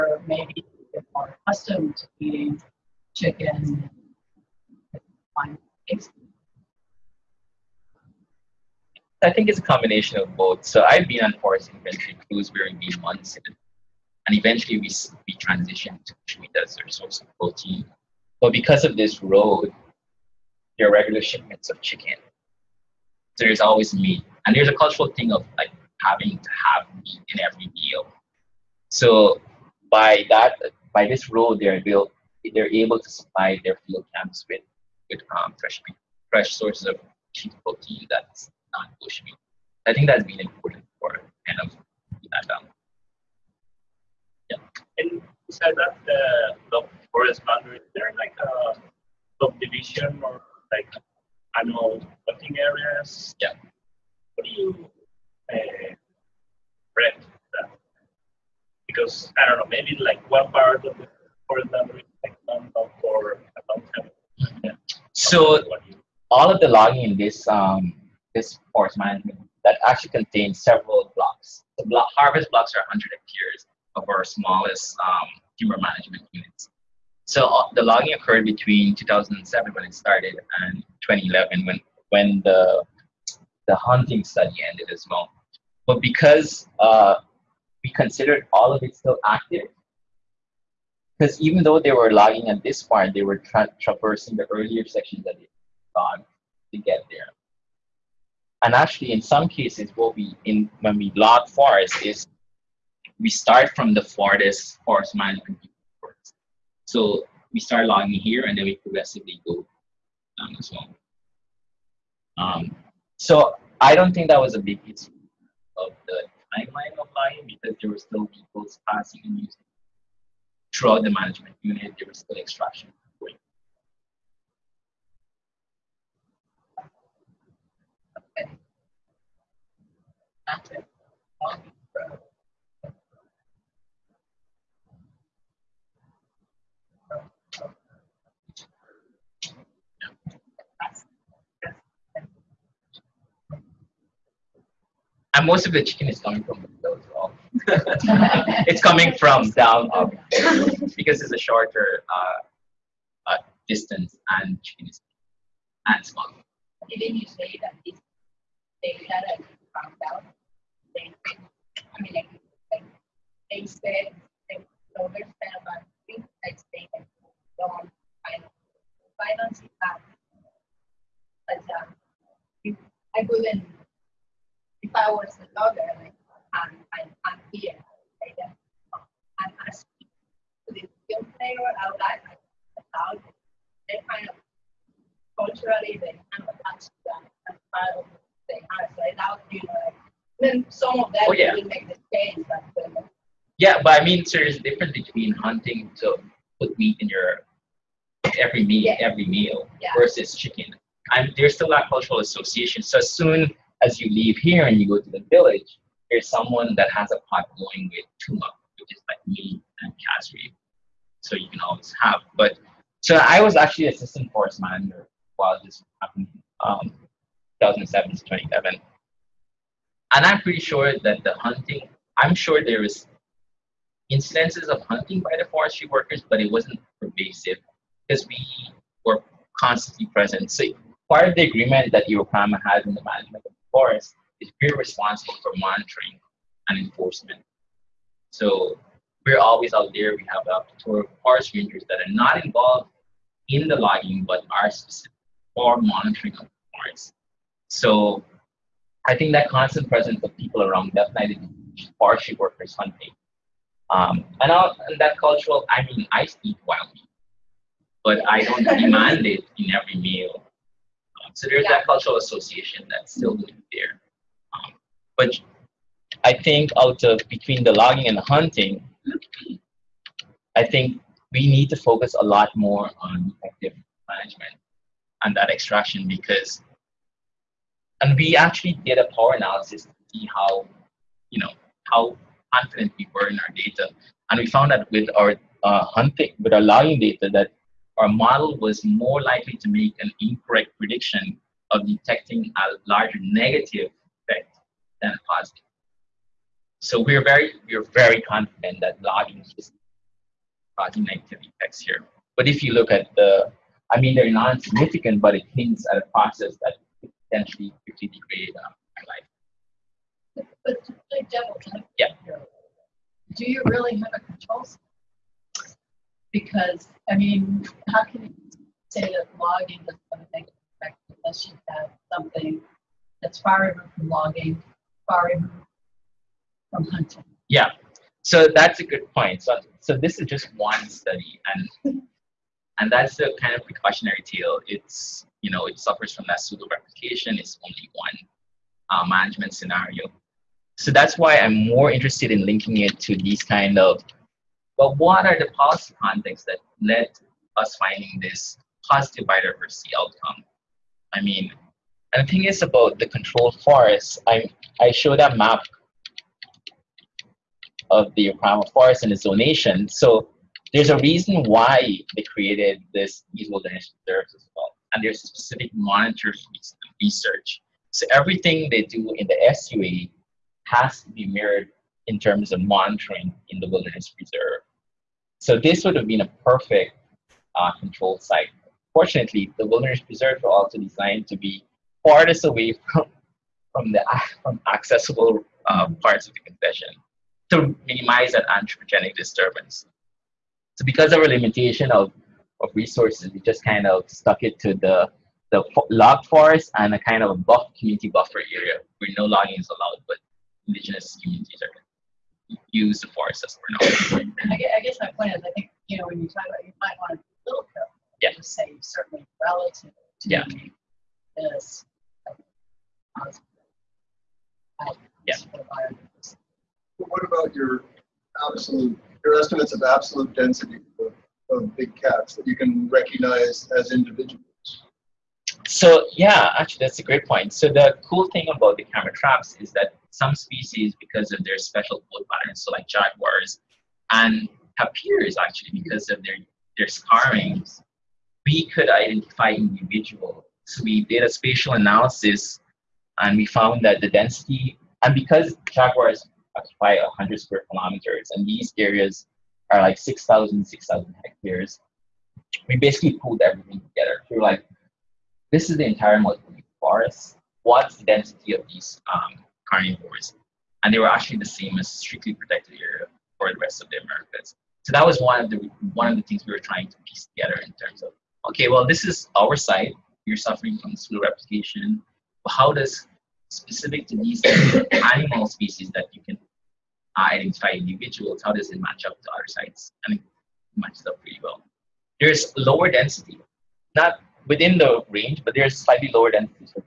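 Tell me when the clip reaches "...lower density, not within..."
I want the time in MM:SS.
08:02.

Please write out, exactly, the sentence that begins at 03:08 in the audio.
So that would know like then some of that oh, yeah.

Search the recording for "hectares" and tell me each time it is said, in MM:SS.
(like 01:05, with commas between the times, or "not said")
01:13, 07:31.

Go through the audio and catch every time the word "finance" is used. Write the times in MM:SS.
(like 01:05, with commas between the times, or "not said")
02:49.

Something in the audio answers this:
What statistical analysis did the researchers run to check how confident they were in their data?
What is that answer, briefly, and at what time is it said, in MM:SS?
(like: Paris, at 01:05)
power analysis, at 04:39.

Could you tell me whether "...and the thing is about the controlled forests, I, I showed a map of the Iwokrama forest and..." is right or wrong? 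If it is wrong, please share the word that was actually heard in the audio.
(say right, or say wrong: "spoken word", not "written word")
right.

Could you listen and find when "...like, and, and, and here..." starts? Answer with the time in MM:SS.
02:55.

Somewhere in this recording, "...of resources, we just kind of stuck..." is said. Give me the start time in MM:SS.
06:32.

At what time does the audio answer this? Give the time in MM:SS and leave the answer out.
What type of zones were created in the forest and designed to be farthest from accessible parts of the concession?
06:03.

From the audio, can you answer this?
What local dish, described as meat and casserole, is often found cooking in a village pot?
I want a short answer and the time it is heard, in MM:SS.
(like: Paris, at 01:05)
tuma, at 03:28.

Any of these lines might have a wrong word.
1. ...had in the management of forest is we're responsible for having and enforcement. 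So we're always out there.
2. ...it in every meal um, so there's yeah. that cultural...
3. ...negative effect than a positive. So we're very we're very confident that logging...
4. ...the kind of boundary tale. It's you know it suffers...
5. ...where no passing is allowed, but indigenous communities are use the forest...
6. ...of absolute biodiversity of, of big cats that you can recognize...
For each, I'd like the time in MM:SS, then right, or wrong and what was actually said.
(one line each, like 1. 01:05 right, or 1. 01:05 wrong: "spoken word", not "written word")
1. 03:52 wrong: "monitoring", not "having"
2. 04:19 right
3. 04:53 right
4. 05:33 wrong: "precautionary", not "boundary"
5. 06:38 wrong: "logging", not "passing"
6. 06:59 wrong: "density", not "biodiversity".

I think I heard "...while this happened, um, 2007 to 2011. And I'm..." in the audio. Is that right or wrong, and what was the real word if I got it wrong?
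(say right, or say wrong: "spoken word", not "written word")
right.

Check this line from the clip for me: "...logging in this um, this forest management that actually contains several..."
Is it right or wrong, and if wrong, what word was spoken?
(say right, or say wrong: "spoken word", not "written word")
right.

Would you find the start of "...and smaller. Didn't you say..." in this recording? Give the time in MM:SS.
02:35.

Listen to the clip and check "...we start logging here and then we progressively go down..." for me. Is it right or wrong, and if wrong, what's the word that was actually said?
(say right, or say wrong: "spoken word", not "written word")
right.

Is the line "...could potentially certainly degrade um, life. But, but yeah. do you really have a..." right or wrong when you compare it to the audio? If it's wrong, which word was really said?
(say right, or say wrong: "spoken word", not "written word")
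wrong: "quickly", not "certainly".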